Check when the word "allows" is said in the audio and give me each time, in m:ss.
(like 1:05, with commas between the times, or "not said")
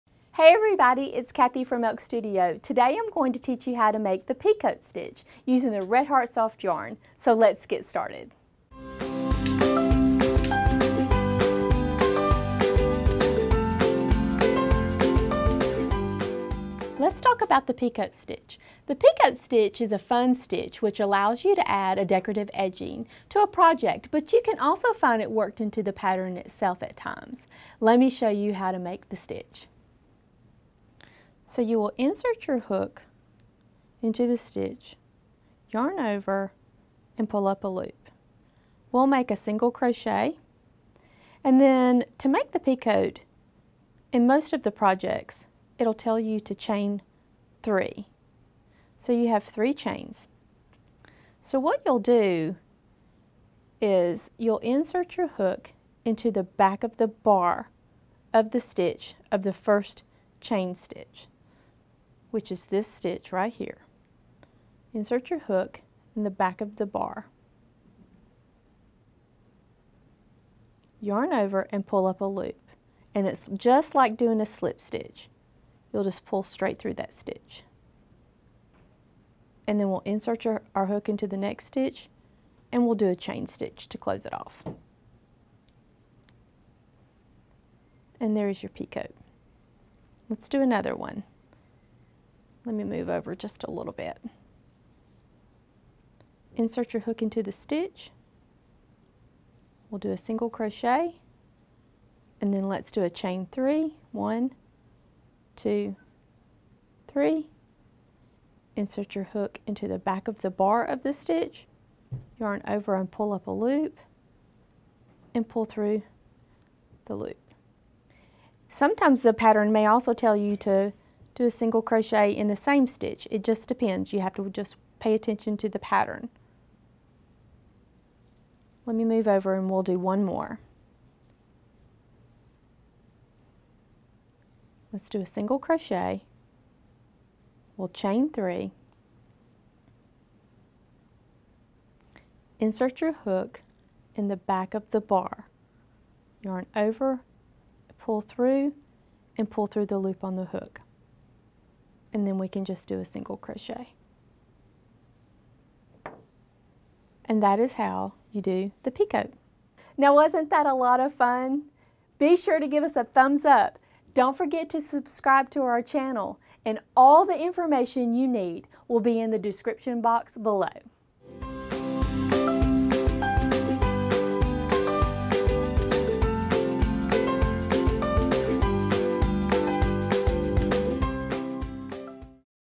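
0:20.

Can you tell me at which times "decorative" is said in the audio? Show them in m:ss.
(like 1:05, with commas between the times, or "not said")
0:22.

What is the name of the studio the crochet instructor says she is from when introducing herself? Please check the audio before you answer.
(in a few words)
Elk Studio.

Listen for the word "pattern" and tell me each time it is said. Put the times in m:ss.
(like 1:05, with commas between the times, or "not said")
0:25, 1:59, 2:05.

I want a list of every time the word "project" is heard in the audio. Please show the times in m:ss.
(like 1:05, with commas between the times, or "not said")
0:23, 0:44.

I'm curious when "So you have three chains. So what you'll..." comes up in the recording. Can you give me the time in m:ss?
0:48.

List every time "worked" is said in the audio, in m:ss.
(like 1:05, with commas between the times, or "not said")
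0:25.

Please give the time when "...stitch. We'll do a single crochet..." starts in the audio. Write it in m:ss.
1:37.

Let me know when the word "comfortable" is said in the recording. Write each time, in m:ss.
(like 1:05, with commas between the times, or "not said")
not said.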